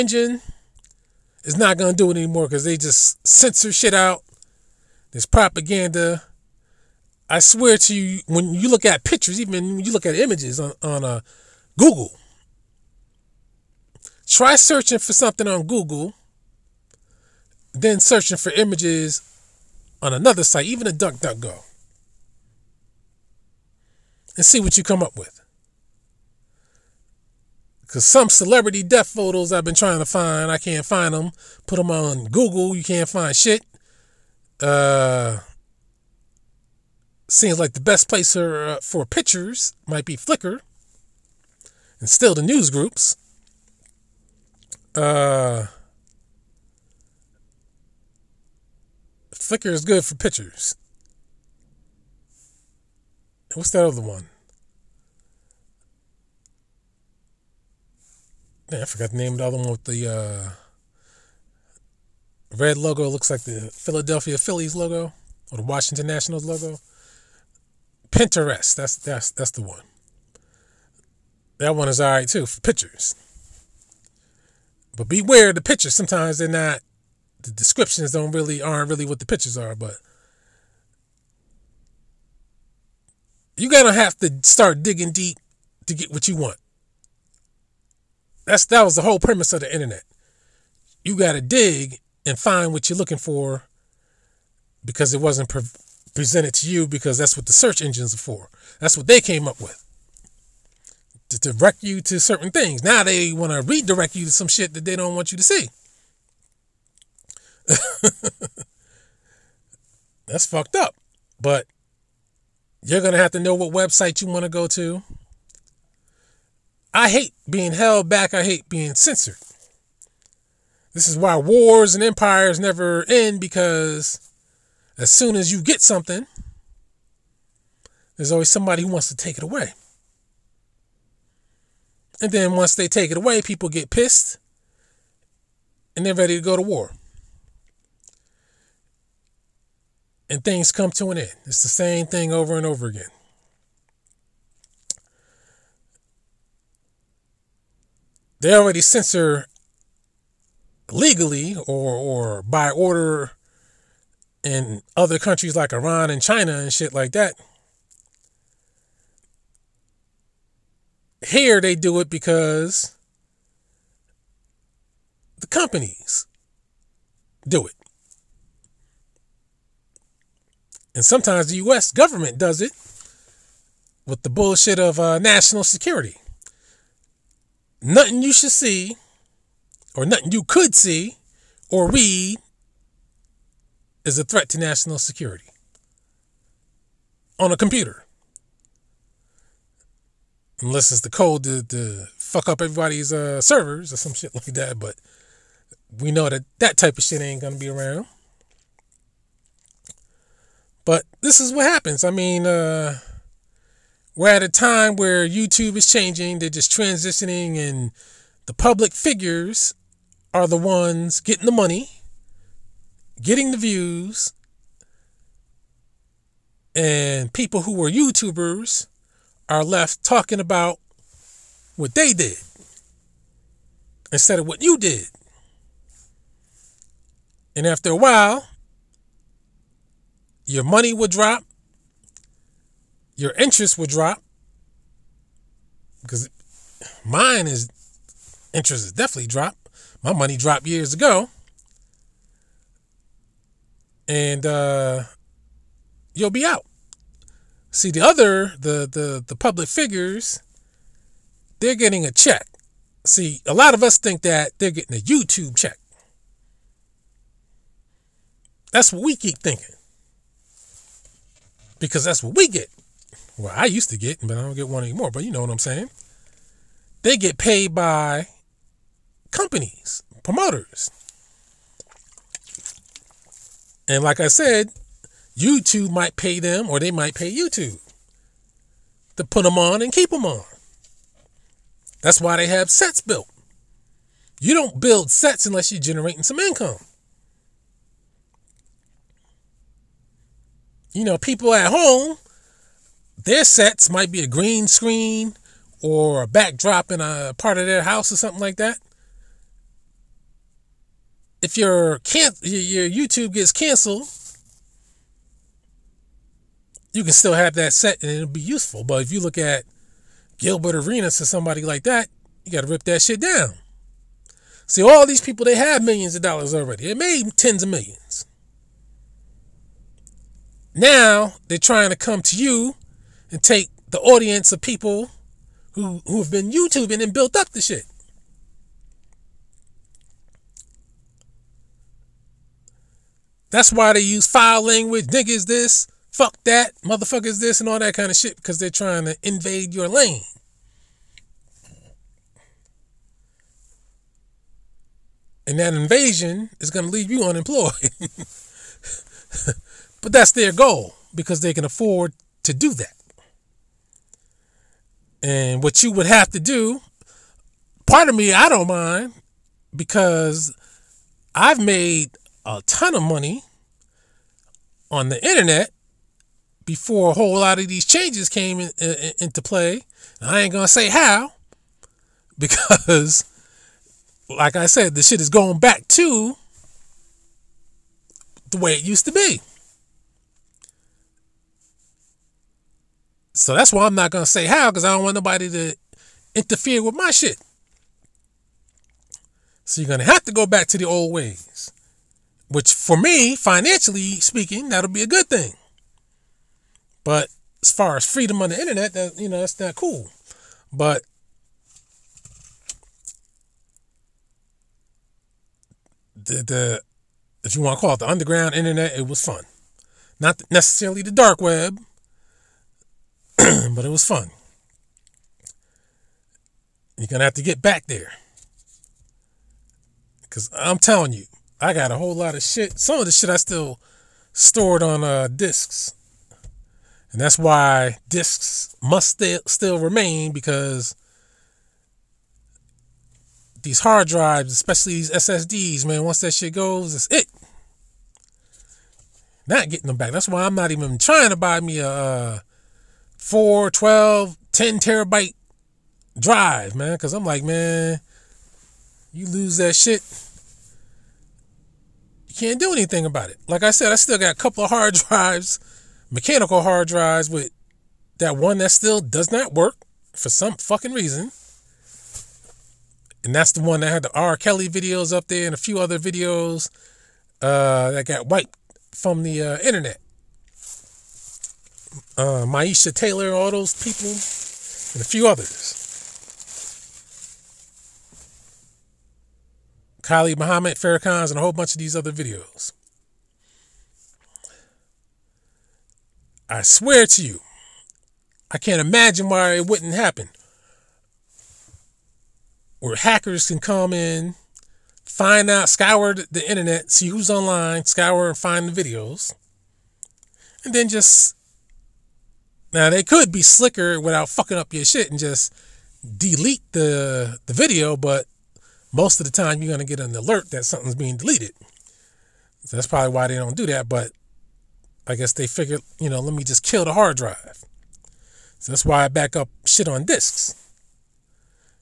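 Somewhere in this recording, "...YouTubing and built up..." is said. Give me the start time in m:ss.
5:26.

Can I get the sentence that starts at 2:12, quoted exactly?
And then once they take it away, people get pissed and they're ready to go to war.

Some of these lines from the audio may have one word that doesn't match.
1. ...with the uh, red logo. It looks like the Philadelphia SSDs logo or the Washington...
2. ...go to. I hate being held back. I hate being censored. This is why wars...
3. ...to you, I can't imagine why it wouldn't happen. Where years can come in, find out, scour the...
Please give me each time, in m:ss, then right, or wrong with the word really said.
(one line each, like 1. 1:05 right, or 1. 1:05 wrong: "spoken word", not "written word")
1. 0:59 wrong: "Phillies", not "SSDs"
2. 1:54 right
3. 8:07 wrong: "hackers", not "years".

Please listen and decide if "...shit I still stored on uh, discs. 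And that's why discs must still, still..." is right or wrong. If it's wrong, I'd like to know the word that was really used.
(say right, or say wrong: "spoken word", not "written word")
right.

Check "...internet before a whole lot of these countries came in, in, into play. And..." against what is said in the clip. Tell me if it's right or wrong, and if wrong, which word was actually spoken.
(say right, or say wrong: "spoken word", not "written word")
wrong: "changes", not "countries".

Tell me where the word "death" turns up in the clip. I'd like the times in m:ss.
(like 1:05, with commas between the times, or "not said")
0:28.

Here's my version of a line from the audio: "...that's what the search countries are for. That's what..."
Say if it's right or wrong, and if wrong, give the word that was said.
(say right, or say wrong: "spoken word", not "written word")
wrong: "engines", not "countries".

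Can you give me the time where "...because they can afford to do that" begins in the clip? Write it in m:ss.
5:51.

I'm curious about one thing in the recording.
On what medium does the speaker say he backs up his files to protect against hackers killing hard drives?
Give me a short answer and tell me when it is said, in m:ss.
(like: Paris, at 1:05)
disks, at 8:40.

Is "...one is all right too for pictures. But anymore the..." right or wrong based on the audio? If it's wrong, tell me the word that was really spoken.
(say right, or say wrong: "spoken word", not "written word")
wrong: "beware", not "anymore".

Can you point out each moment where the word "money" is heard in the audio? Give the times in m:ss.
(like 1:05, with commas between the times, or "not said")
3:31, 3:50, 4:00, 6:03.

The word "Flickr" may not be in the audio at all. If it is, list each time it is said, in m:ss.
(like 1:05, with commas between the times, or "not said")
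0:40, 0:49.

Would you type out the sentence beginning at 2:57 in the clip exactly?
Nothing you should see, or nothing you could see, or read is a threat to national security on a computer.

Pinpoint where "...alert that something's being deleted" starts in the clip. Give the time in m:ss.
8:30.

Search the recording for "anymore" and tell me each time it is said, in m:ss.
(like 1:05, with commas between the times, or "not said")
0:02, 4:24.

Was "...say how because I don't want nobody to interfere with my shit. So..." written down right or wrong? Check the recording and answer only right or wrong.
right.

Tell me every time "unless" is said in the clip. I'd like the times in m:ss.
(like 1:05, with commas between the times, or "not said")
3:10, 4:45.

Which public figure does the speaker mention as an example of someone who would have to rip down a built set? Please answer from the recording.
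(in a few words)
Gilbert Arenas.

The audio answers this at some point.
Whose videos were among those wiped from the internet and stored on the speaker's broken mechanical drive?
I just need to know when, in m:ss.
7:44.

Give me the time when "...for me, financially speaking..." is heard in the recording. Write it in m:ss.
6:32.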